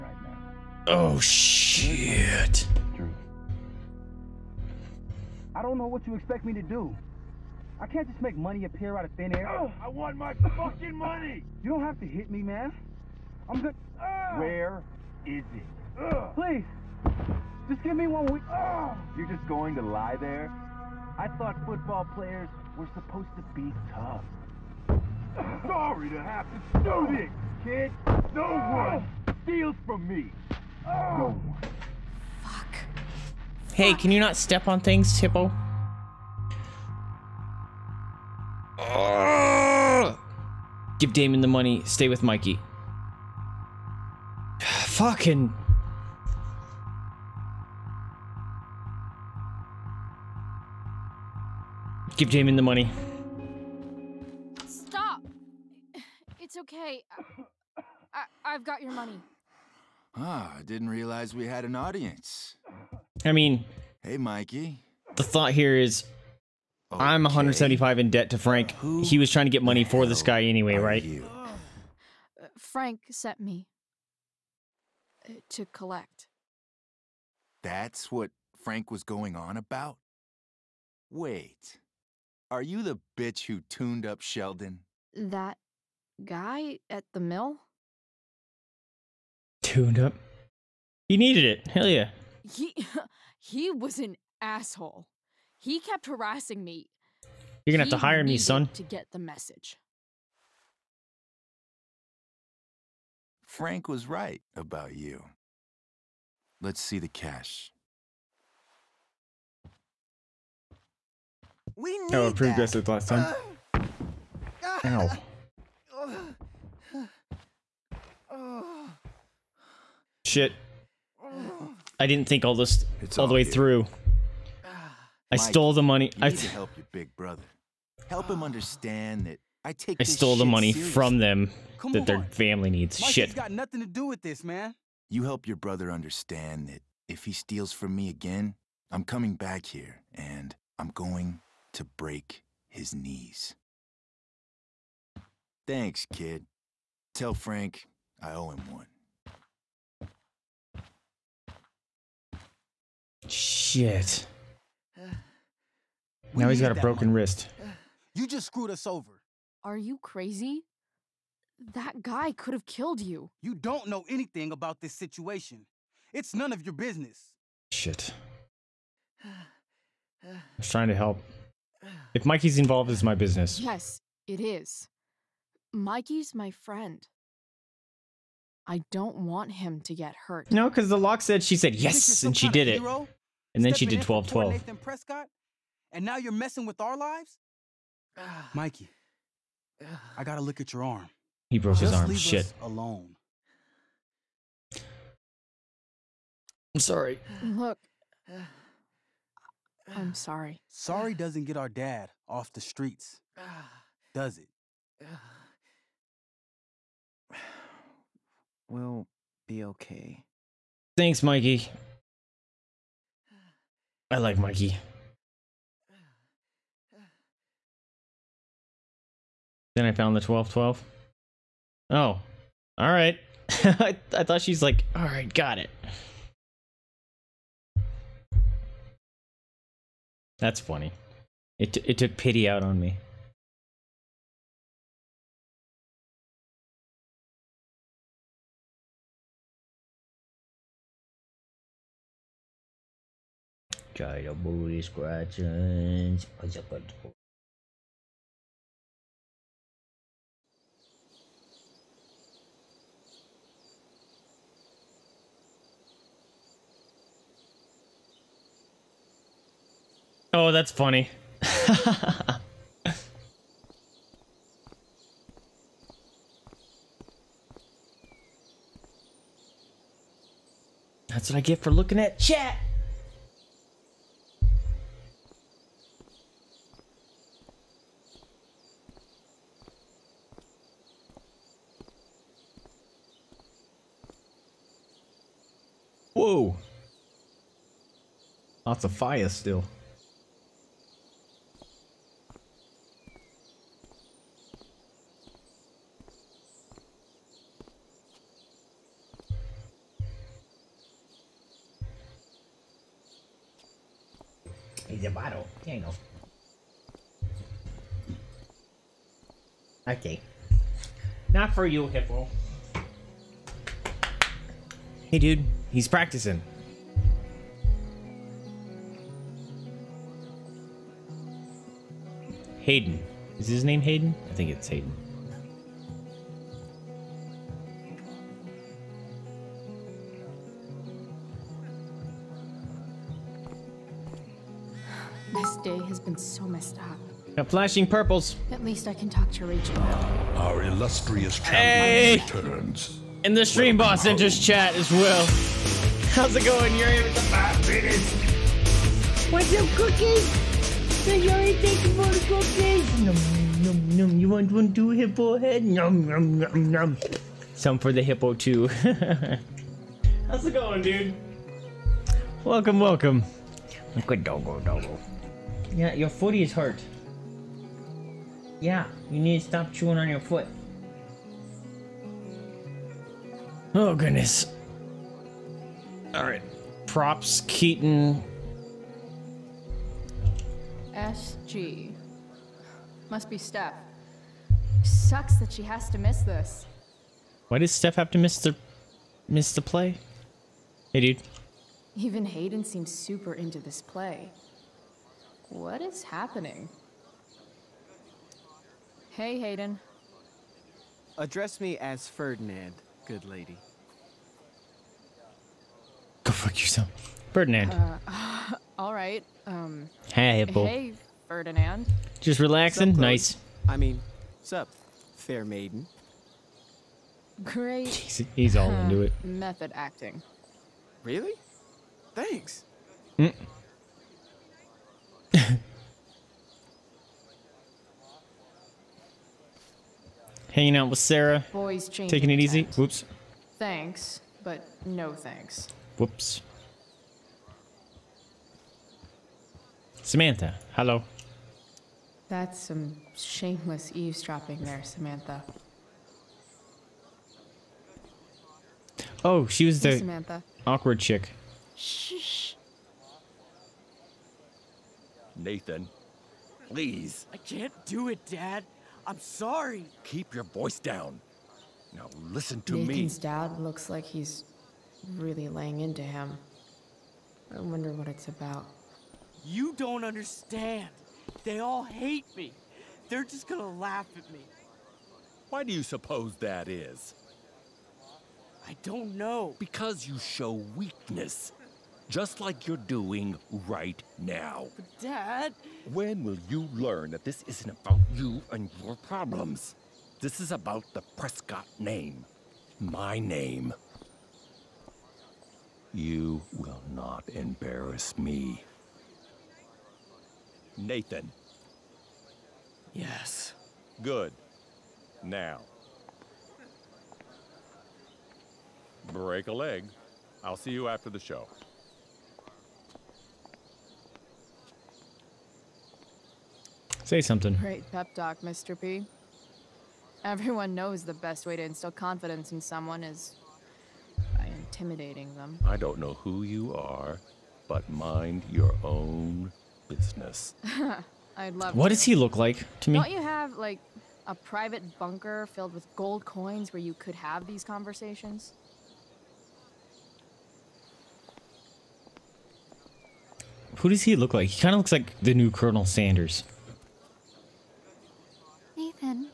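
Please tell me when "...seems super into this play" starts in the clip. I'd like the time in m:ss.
6:32.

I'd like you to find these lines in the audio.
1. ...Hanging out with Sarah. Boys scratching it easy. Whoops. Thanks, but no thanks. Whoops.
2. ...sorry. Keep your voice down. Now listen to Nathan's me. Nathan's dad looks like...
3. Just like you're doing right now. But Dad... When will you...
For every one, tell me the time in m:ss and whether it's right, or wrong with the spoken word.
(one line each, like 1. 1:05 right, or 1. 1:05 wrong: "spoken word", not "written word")
1. 7:10 wrong: "taking", not "scratching"
2. 7:39 right
3. 8:02 right.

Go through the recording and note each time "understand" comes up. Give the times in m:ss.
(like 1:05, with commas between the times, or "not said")
2:08, 2:15, 7:50.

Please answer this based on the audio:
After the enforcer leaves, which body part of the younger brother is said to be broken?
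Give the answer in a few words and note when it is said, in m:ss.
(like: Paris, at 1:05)
Wrist, at 2:37.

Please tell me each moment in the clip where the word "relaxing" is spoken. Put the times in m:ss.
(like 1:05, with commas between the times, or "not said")
6:52.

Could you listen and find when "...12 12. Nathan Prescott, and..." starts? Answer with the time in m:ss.
3:04.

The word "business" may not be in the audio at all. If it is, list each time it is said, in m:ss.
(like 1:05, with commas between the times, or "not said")
2:46, 2:53, 8:49.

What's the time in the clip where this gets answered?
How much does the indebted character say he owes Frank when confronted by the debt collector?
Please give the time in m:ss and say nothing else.
1:07.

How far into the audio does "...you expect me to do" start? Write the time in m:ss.
0:06.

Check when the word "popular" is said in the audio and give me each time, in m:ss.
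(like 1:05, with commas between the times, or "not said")
not said.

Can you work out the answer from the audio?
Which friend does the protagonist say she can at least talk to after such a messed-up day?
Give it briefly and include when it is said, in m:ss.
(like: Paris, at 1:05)
Rachel, at 5:39.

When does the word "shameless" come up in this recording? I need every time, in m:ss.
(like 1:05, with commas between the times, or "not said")
7:23.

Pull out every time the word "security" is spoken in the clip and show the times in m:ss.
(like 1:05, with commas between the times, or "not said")
not said.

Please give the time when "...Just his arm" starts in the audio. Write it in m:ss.
3:11.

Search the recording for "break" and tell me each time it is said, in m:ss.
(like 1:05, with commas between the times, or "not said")
2:21, 8:29.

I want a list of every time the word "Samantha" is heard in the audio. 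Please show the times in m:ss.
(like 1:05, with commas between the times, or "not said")
7:20, 7:24, 7:29.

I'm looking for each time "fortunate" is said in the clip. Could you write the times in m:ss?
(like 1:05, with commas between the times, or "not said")
not said.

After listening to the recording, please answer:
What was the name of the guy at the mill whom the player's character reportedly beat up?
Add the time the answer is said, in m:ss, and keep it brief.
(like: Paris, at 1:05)
Sheldon, at 1:24.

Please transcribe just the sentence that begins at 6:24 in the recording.
Sucks that she has to miss this.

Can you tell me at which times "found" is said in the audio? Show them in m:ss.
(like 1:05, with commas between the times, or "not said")
3:39.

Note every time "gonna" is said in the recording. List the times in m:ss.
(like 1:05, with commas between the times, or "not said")
1:37, 7:53.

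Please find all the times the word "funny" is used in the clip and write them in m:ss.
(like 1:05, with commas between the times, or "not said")
3:50, 4:20.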